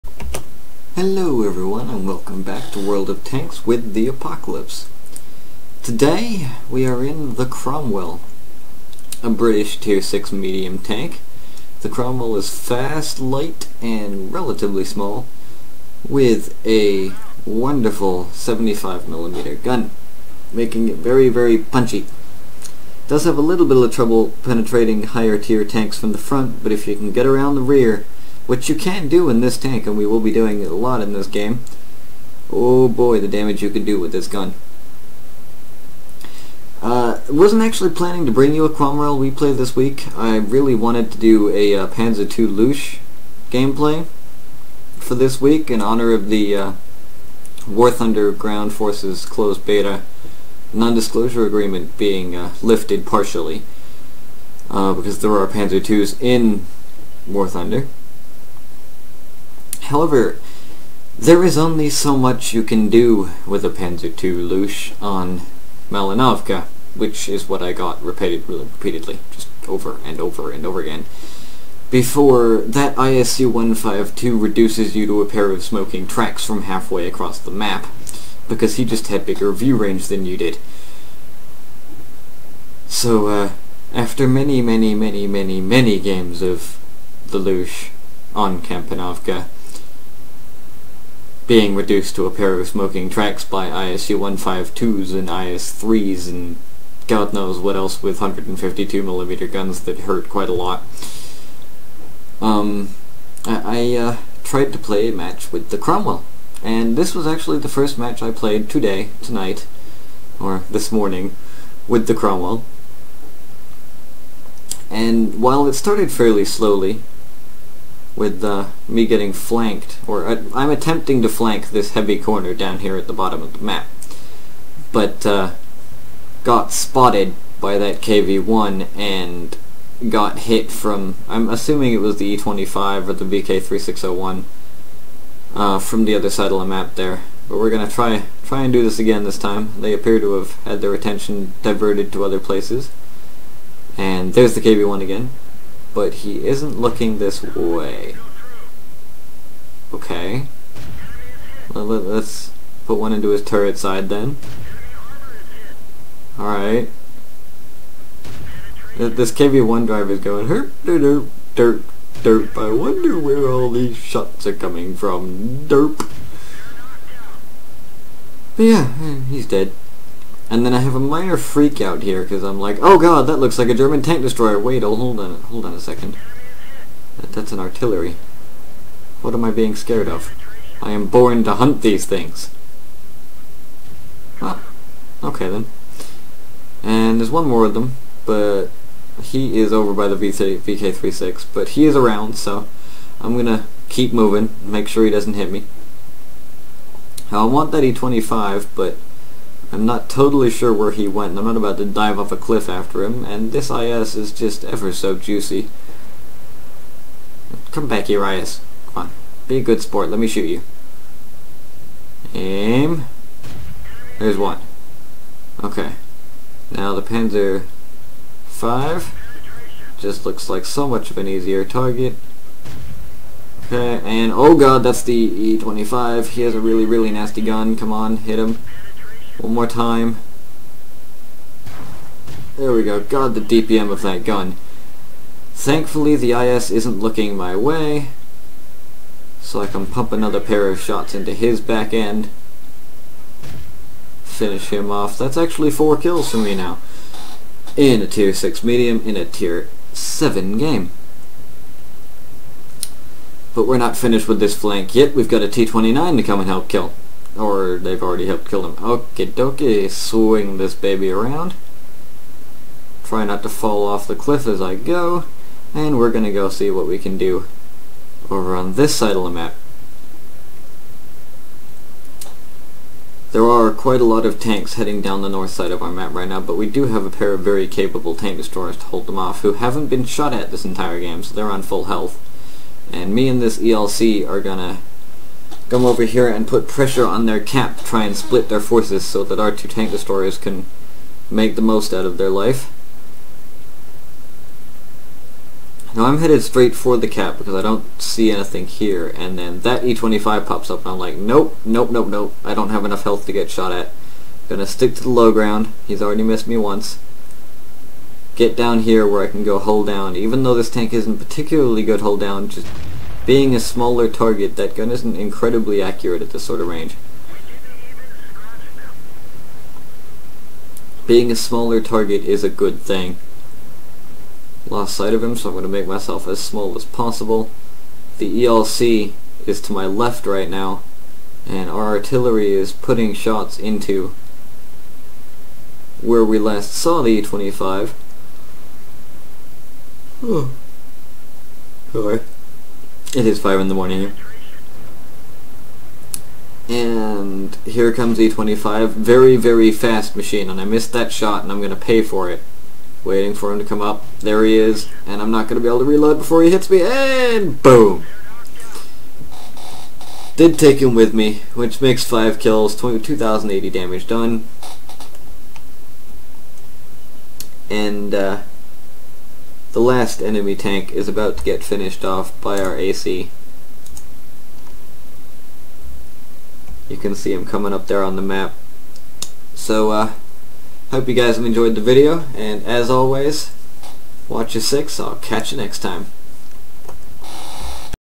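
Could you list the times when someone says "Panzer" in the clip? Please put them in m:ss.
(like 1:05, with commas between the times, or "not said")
0:41, 0:55, 1:03, 3:37.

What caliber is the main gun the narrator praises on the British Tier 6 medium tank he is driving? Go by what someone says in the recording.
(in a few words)
75mm.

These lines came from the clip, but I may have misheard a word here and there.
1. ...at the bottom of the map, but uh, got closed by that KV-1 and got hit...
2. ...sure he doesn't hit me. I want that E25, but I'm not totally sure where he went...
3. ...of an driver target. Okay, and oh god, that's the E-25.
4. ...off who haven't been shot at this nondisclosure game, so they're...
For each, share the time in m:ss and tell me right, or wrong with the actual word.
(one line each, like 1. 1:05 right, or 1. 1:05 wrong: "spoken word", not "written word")
1. 2:02 wrong: "spotted", not "closed"
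2. 3:14 right
3. 3:41 wrong: "easier", not "driver"
4. 4:39 wrong: "entire", not "nondisclosure".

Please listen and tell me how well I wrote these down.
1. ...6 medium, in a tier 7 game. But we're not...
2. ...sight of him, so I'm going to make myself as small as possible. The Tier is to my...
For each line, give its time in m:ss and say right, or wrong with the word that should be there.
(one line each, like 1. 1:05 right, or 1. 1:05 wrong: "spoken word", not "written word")
1. 4:08 right
2. 5:24 wrong: "ELC", not "Tier".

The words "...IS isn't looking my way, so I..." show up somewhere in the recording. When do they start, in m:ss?
3:56.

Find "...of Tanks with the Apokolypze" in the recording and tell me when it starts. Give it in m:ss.
0:03.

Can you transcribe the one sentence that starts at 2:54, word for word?
Wait, oh, hold on, hold on a second.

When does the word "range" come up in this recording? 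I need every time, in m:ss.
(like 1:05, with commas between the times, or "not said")
1:19, 5:16.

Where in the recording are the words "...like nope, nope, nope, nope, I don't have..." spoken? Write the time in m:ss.
5:00.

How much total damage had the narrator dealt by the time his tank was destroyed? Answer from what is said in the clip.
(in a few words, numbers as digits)
2,080.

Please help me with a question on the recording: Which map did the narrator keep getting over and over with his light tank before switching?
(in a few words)
Malinovka.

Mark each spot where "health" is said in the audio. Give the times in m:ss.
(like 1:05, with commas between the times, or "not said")
4:41, 5:03.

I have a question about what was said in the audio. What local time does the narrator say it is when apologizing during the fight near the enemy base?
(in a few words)
5 in the morning.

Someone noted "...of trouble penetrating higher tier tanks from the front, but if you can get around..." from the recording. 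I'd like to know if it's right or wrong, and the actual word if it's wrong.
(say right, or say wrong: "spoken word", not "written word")
right.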